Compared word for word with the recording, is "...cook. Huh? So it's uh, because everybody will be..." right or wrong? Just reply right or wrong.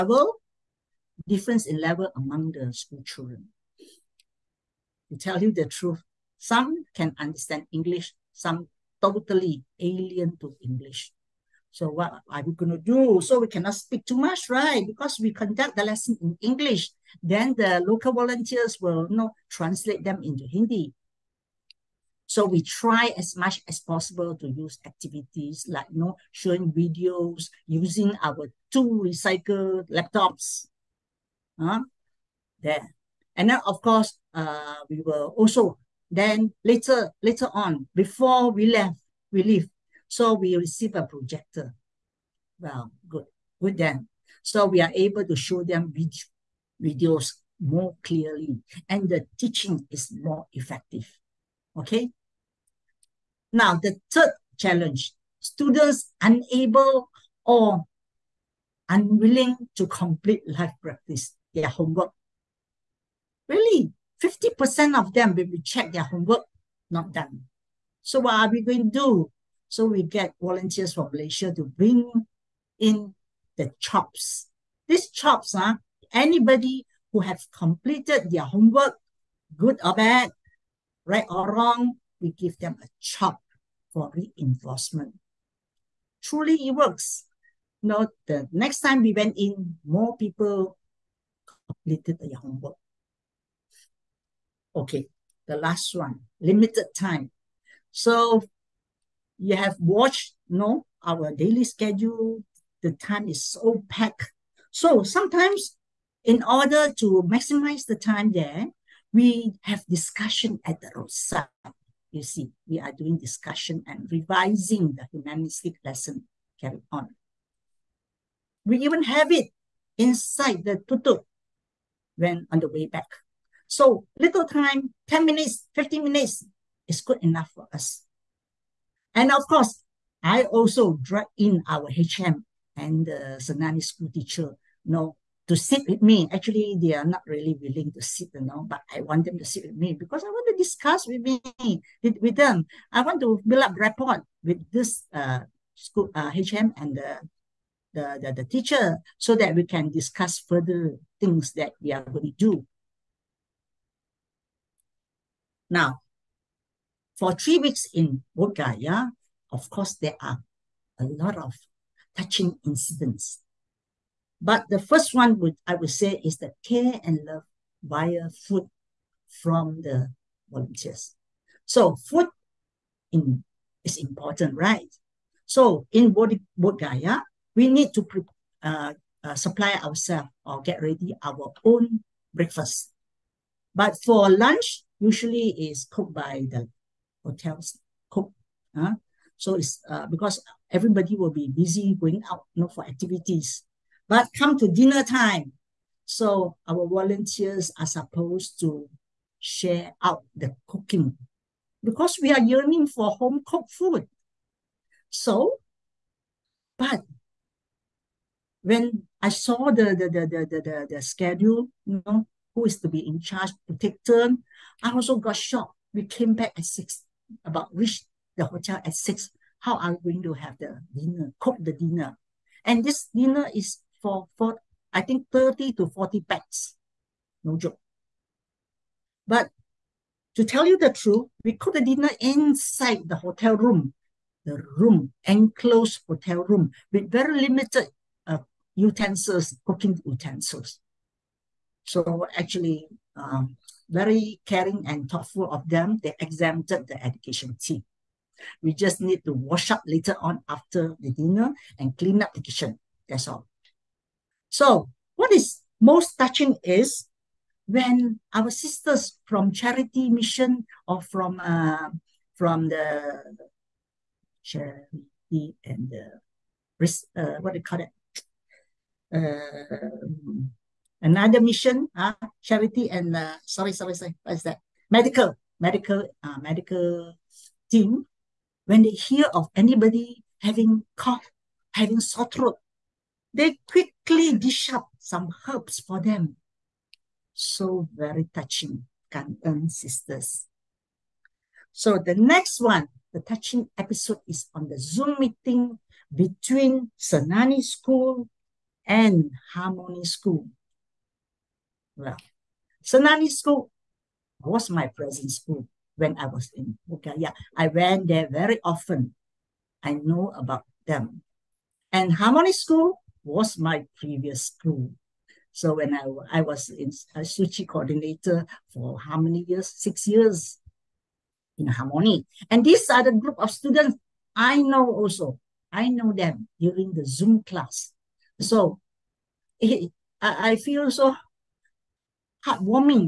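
right.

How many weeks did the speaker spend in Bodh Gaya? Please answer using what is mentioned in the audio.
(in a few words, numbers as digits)
3.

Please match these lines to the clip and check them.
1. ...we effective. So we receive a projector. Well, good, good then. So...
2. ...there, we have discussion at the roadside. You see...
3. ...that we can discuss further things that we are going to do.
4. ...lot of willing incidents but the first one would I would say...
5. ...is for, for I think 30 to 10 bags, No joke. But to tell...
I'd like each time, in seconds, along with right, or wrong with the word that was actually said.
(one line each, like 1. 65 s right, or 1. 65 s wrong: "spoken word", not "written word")
1. 39 s wrong: "leave", not "effective"
2. 108 s right
3. 149 s right
4. 161 s wrong: "touching", not "willing"
5. 223 s wrong: "40", not "10".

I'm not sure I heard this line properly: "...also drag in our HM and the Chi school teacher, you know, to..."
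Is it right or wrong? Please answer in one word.
wrong.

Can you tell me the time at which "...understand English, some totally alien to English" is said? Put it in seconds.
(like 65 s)
7 s.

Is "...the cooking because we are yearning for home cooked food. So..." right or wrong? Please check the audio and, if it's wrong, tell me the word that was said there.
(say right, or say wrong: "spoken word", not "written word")
right.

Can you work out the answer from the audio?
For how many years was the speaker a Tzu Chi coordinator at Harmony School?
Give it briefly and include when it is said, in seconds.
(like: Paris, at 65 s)
6, at 319 s.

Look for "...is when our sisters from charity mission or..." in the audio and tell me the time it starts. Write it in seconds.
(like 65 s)
256 s.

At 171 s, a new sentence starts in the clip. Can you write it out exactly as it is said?
So food in, is important, right?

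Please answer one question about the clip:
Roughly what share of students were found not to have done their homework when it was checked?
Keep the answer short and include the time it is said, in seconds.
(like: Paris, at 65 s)
50%, at 64 s.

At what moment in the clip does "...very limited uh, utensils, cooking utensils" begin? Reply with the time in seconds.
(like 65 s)
237 s.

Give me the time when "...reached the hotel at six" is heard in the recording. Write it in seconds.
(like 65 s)
217 s.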